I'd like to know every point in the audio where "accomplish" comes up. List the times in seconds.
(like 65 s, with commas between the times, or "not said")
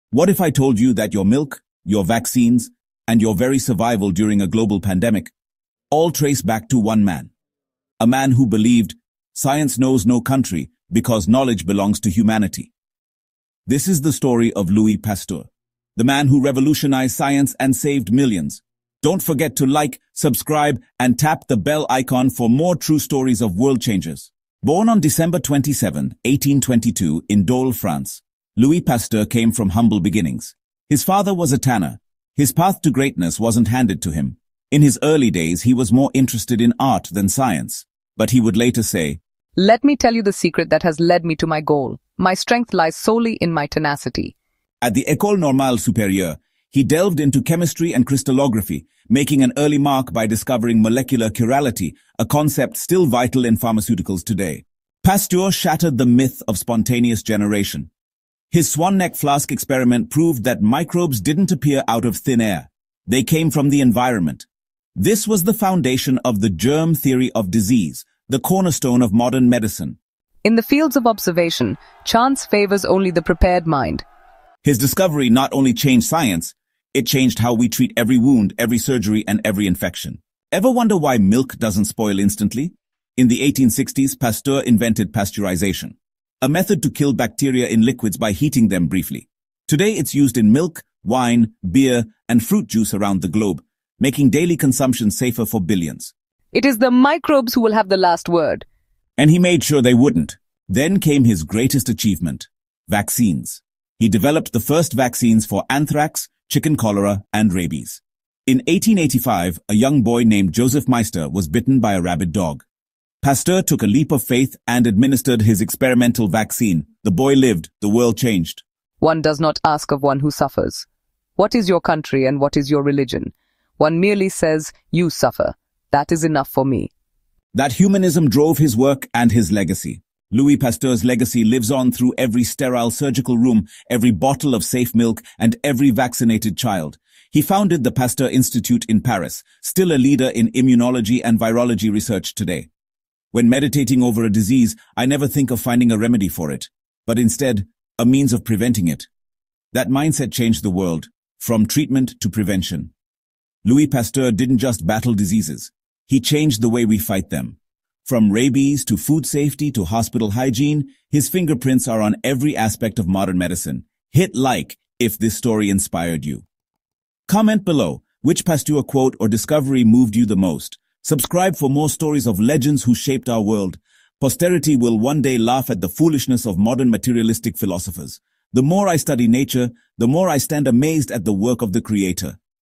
not said.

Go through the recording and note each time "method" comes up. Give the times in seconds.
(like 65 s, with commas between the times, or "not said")
86 s.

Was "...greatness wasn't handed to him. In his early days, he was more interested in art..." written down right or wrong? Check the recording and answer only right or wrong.
right.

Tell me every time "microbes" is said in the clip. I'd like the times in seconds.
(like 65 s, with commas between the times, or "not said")
60 s, 96 s.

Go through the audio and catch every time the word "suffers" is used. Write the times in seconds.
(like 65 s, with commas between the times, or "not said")
120 s, 125 s.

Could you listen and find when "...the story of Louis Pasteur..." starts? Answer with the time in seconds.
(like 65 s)
14 s.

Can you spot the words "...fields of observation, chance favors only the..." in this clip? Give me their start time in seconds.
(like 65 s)
70 s.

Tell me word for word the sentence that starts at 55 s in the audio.
Pasteur shattered the myth of spontaneous generation.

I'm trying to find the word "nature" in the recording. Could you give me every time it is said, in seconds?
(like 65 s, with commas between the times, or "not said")
179 s.